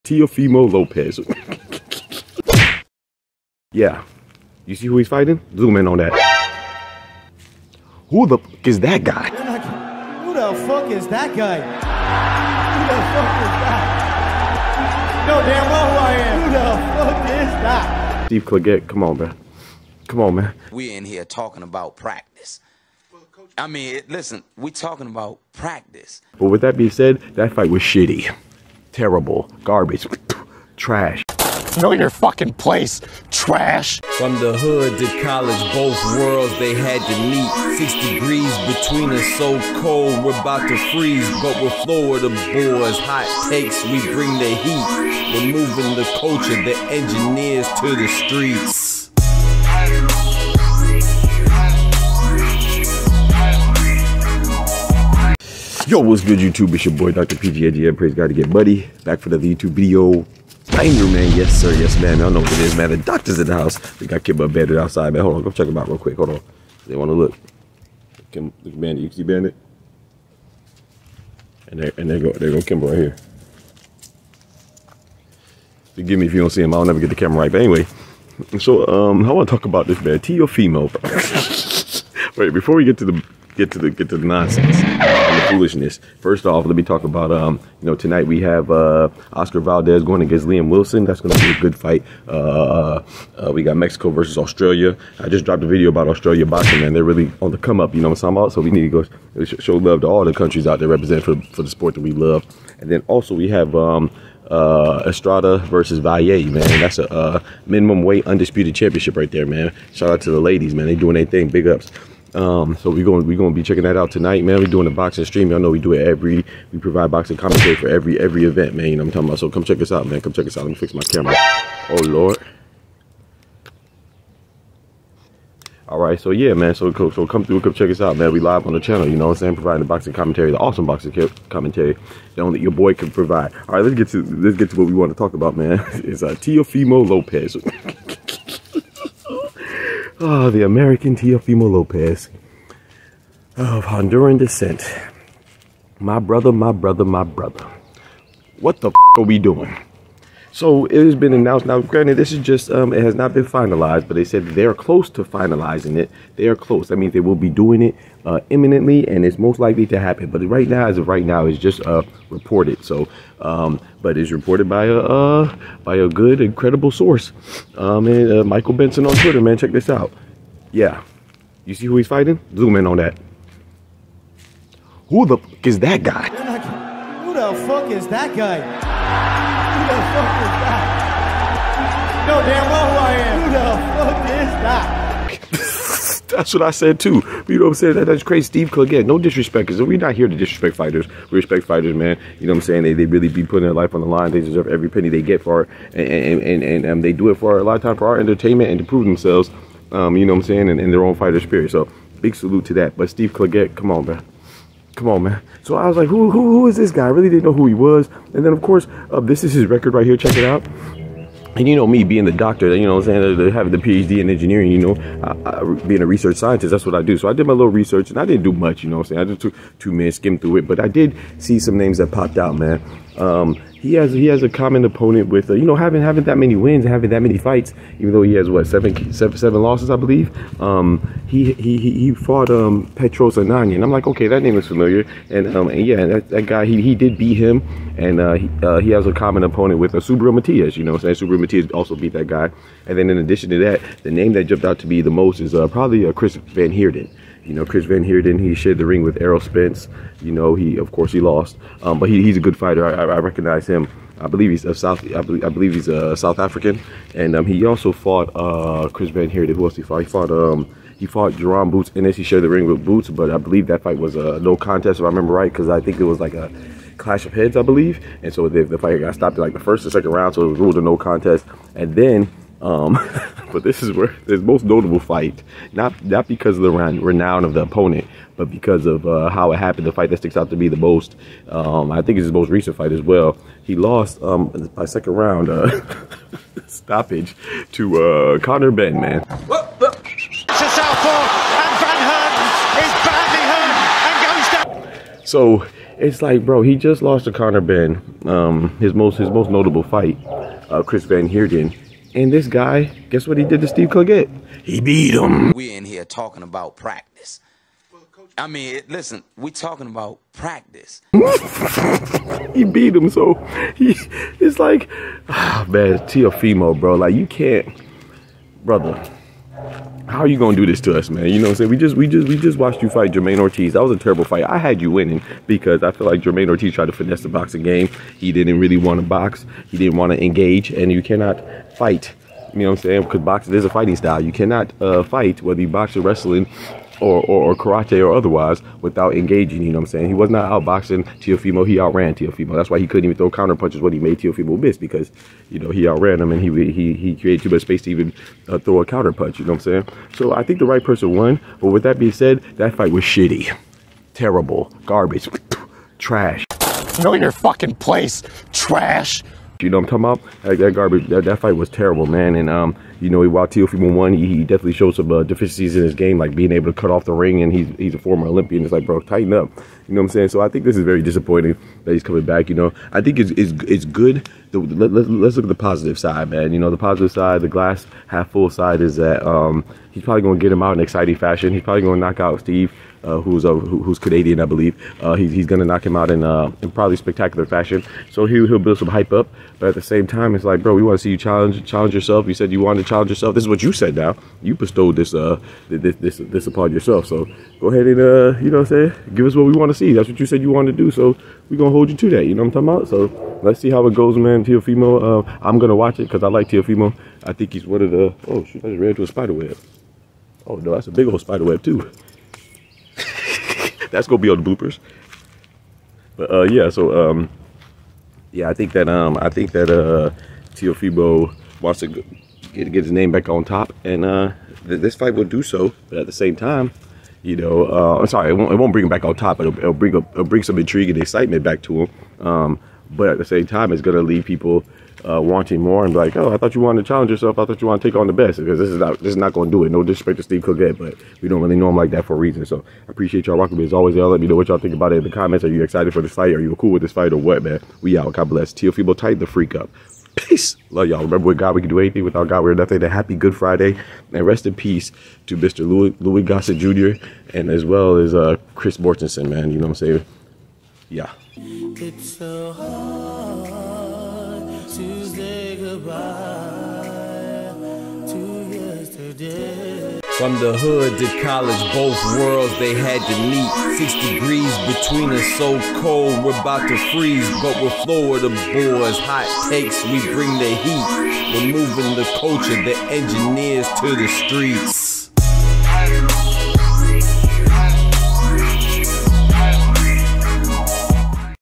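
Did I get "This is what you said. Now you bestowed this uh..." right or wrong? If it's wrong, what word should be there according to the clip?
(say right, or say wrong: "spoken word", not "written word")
right.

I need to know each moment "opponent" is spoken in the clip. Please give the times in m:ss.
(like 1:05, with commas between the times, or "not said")
3:44, 3:59, 4:37.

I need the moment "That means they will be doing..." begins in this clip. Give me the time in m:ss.
2:36.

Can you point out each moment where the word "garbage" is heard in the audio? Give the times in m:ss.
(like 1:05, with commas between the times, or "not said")
0:29, 5:54, 6:00.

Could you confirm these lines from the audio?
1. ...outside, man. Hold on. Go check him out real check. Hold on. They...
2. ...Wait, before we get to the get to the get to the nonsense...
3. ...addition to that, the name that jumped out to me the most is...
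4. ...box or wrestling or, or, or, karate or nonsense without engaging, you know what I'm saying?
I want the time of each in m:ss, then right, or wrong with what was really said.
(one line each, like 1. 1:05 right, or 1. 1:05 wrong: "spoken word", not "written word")
1. 1:04 wrong: "quick", not "check"
2. 1:22 right
3. 4:03 right
4. 5:35 wrong: "otherwise", not "nonsense".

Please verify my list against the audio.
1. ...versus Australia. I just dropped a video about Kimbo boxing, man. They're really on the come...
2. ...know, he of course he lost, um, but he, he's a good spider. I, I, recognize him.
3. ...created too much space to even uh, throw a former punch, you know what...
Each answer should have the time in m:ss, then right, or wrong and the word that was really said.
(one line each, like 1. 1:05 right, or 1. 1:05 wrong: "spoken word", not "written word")
1. 1:34 wrong: "Australia", not "Kimbo"
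2. 4:10 wrong: "fighter", not "spider"
3. 5:47 wrong: "counter", not "former".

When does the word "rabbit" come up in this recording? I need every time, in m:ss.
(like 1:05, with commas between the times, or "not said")
not said.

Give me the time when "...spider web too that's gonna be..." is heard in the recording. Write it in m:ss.
6:51.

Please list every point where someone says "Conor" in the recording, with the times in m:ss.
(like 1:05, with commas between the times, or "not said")
4:48, 4:57.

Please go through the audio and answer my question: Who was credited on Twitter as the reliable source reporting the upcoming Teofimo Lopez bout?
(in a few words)
Michael Benson.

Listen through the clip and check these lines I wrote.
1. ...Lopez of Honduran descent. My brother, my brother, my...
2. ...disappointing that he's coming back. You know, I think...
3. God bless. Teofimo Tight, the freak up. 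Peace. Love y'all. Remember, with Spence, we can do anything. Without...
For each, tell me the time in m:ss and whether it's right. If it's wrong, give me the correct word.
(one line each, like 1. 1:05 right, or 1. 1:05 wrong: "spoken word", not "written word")
1. 2:21 right
2. 6:11 right
3. 7:28 wrong: "God", not "Spence".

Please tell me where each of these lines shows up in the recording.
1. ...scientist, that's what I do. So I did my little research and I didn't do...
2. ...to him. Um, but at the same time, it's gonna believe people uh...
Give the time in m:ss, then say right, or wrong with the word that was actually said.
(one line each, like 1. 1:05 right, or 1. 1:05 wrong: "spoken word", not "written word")
1. 3:36 right
2. 7:11 wrong: "leave", not "believe".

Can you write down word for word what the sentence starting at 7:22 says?
So I appreciate y'all rocking with As always, y'all let me know what y'all think about it in the comments.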